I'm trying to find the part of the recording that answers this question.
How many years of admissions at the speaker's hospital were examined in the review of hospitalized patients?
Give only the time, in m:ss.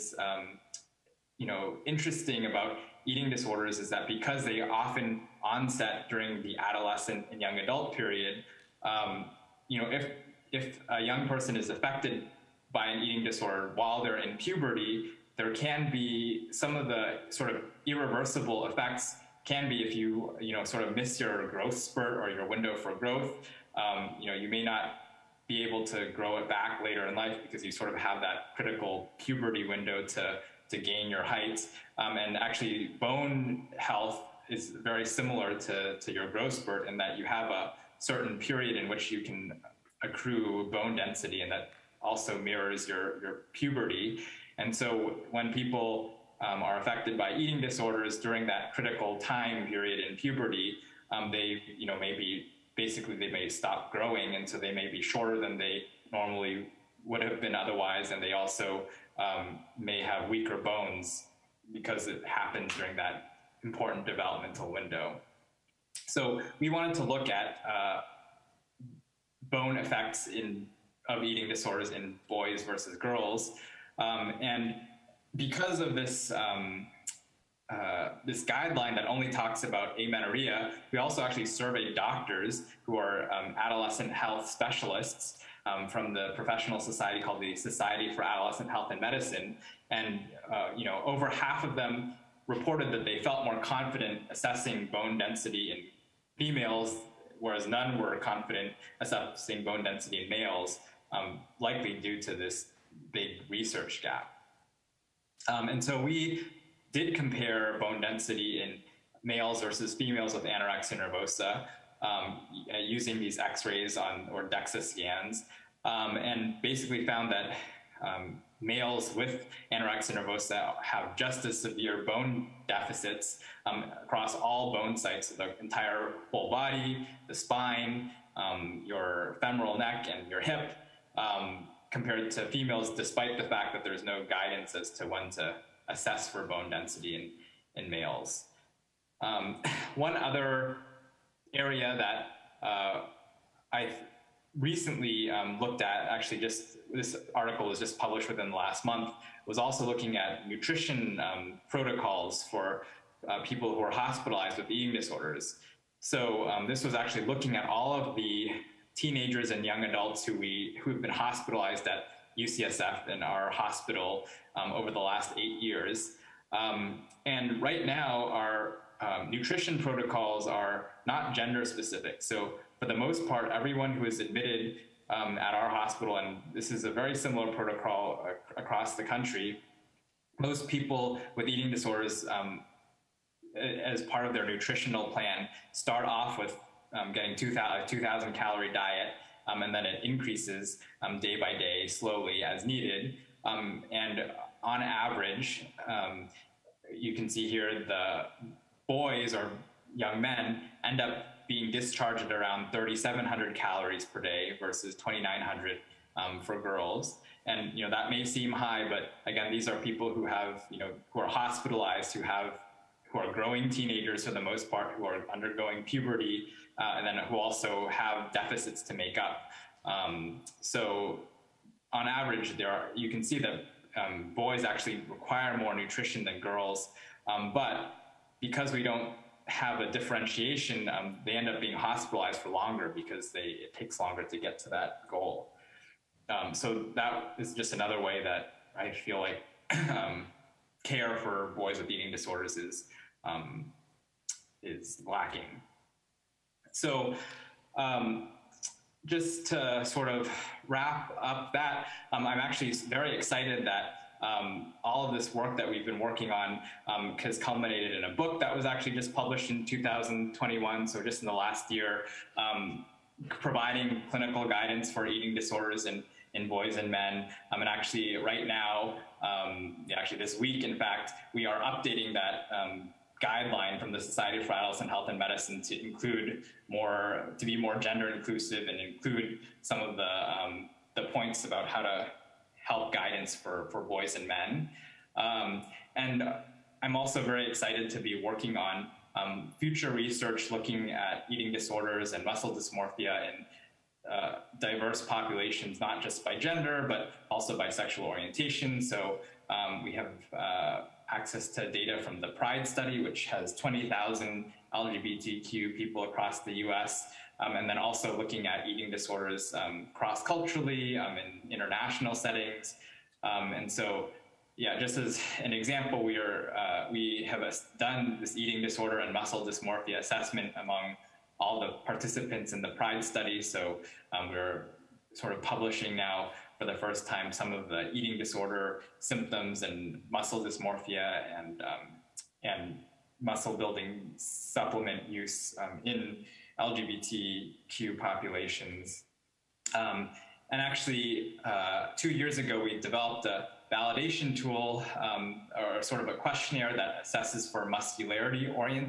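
2:45.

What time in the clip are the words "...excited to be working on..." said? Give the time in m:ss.
4:47.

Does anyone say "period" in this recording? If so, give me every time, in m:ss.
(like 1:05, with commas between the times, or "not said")
0:07, 0:38, 0:49.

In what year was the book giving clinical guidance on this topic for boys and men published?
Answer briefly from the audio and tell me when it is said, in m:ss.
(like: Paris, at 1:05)
2021, at 4:19.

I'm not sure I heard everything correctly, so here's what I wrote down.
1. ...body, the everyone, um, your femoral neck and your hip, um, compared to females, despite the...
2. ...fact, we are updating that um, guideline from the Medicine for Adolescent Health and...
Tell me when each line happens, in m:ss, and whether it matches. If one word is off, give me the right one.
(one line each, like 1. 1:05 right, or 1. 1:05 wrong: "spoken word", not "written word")
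1. 2:06 wrong: "spine", not "everyone"
2. 4:30 wrong: "Society", not "Medicine".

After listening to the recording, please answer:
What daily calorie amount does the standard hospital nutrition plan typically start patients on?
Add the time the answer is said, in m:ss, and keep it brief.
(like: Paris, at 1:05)
2,000, at 3:07.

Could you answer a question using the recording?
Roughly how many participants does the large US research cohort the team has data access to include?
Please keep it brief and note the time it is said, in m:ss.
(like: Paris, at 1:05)
20,000, at 5:03.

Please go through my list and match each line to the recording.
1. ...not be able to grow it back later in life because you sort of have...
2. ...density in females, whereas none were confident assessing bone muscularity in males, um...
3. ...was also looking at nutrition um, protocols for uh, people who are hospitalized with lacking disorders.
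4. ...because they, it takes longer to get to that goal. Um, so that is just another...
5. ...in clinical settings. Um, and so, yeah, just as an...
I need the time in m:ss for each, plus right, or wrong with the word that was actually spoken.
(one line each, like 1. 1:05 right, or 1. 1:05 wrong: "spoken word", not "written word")
1. 0:24 right
2. 1:35 wrong: "density", not "muscularity"
3. 2:29 wrong: "eating", not "lacking"
4. 3:52 right
5. 5:11 wrong: "international", not "clinical".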